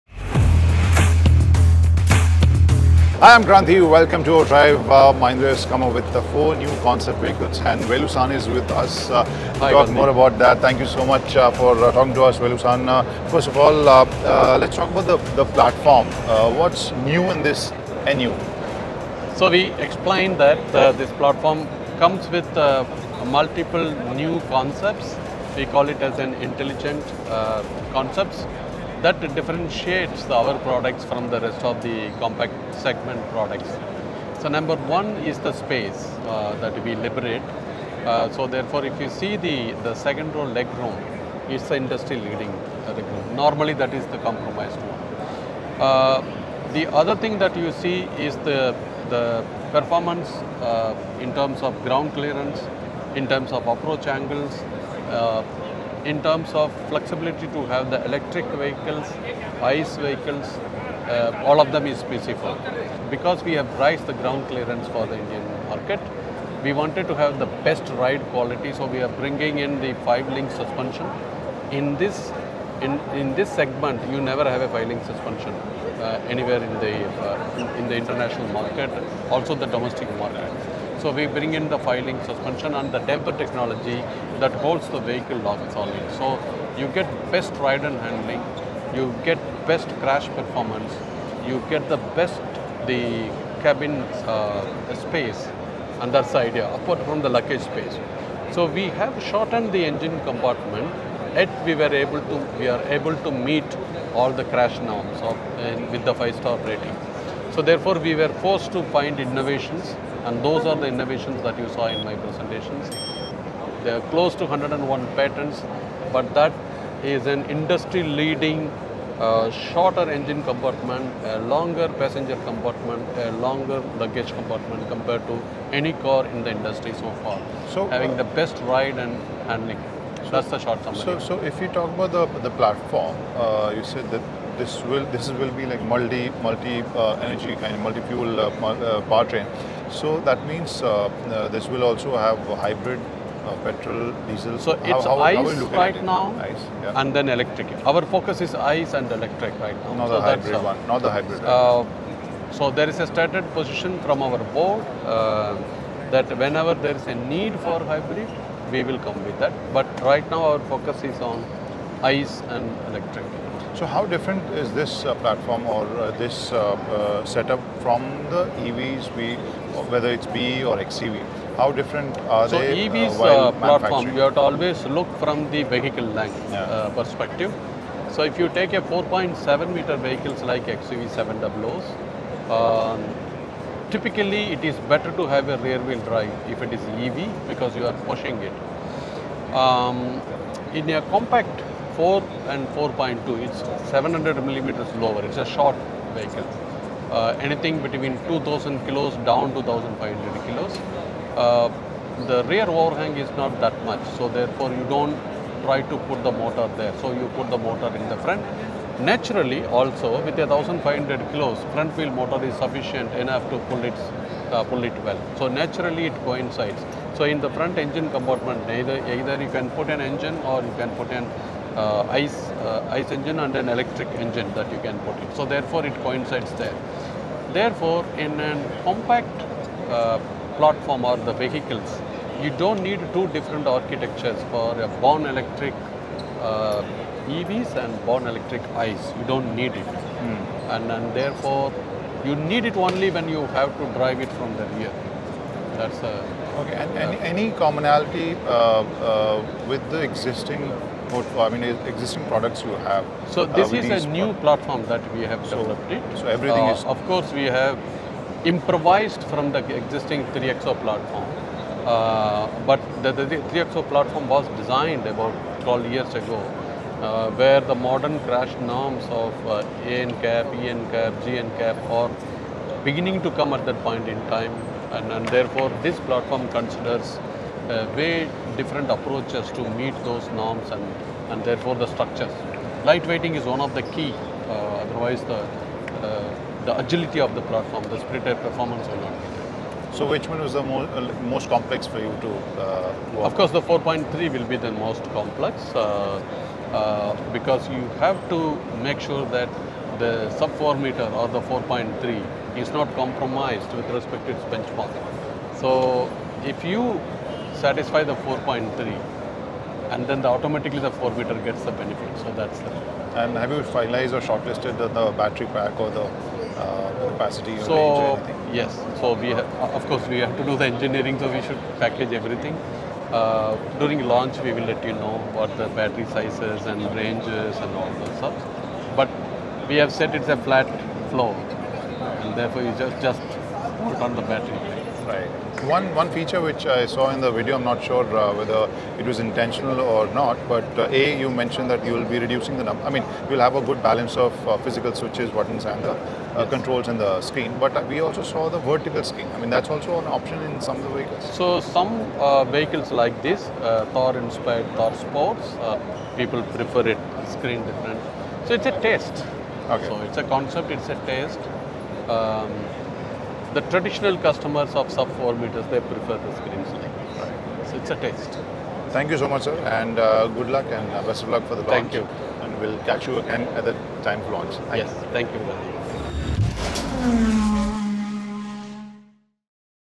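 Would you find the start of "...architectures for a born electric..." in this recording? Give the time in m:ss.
3:53.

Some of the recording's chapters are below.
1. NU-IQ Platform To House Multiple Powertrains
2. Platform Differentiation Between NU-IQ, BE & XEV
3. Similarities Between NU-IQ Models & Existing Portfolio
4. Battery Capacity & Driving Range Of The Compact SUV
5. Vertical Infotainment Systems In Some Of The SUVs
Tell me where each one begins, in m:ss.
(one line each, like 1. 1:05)
1. 2:11
2. 2:43
3. 4:07
4. 5:13
5. 5:35.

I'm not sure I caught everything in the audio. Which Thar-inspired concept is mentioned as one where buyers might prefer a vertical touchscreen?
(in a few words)
Thar Sports.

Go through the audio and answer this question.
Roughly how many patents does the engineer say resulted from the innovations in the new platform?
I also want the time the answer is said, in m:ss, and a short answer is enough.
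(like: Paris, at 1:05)
101, at 1:54.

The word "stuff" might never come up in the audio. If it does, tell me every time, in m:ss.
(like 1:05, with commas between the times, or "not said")
5:28.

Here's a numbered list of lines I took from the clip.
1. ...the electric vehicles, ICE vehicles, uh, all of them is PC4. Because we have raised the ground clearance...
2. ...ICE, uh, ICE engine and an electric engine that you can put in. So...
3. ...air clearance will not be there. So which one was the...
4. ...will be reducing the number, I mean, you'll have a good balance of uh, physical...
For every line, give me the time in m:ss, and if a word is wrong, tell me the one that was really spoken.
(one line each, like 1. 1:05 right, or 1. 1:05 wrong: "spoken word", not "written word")
1. 0:57 right
2. 3:42 right
3. 4:48 wrong: "performance", not "clearance"
4. 5:41 right.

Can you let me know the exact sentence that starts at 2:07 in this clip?
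So uh, having uh, the best ride and handling.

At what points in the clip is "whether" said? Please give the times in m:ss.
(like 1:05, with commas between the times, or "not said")
2:49, 5:38.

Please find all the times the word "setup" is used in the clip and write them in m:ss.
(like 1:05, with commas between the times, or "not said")
2:47.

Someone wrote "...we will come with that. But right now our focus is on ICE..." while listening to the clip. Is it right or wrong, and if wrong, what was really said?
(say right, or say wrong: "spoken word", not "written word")
right.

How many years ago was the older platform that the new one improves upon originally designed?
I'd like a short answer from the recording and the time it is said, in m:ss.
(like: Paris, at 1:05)
12, at 4:25.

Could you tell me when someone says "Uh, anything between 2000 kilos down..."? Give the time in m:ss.
3:17.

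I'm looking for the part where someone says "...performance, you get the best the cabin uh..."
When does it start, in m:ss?
1:30.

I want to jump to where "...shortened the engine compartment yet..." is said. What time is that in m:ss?
1:39.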